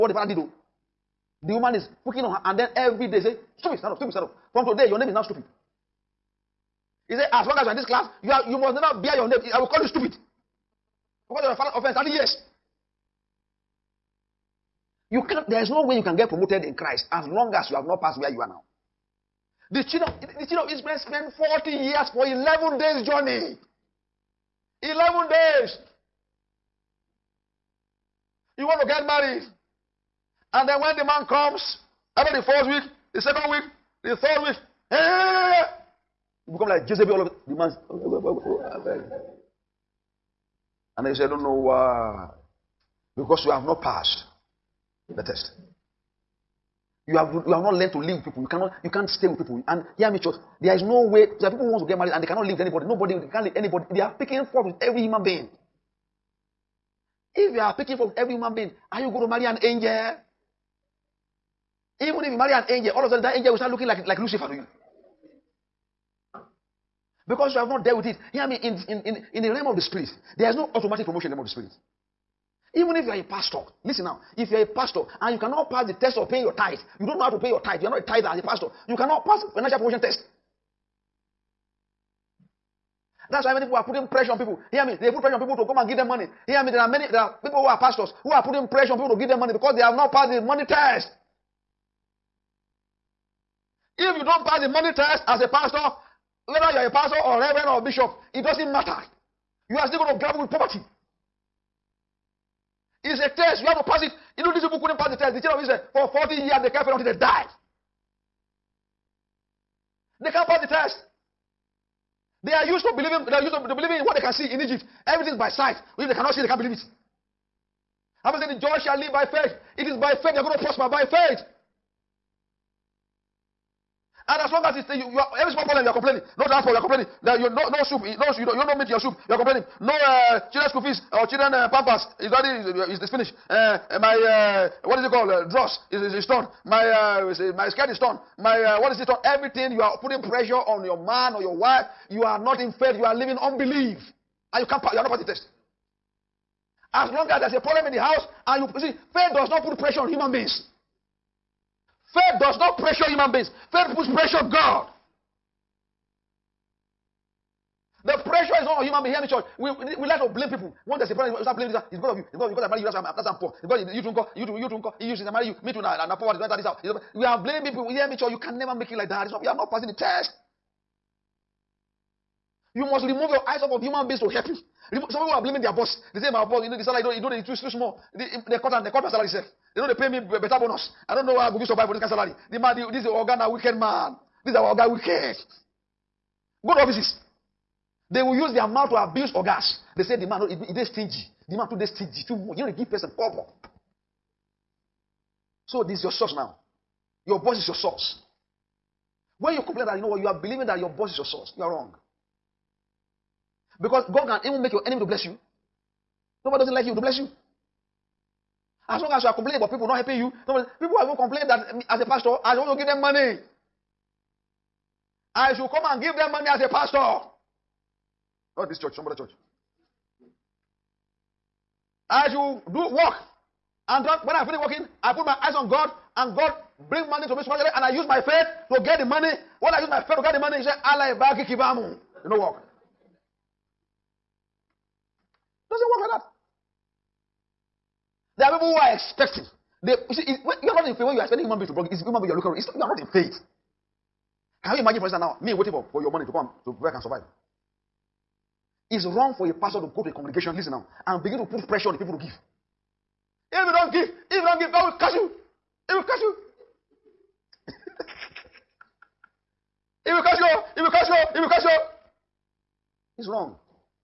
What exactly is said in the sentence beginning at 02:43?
It's because you drink, you drink, you drink, you since I marry you.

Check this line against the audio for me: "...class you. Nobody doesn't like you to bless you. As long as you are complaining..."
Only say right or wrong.
wrong.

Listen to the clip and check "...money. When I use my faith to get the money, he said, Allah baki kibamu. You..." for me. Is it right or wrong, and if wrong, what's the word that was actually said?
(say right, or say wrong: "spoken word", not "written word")
right.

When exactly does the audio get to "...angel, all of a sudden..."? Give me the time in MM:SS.
01:02.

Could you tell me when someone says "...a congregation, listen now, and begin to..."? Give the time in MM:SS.
04:10.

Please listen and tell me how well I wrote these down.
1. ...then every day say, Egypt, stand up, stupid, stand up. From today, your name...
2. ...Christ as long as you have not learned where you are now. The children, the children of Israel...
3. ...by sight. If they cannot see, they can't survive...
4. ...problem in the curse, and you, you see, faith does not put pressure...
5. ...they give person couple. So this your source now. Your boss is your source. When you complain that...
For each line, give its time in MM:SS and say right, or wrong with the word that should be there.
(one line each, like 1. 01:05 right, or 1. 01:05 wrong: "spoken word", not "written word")
1. 00:02 wrong: "Stupid", not "Egypt"
2. 00:16 wrong: "passed", not "learned"
3. 01:55 wrong: "believe", not "survive"
4. 02:27 wrong: "house", not "curse"
5. 03:12 right.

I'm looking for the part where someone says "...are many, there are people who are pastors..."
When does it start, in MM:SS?
01:26.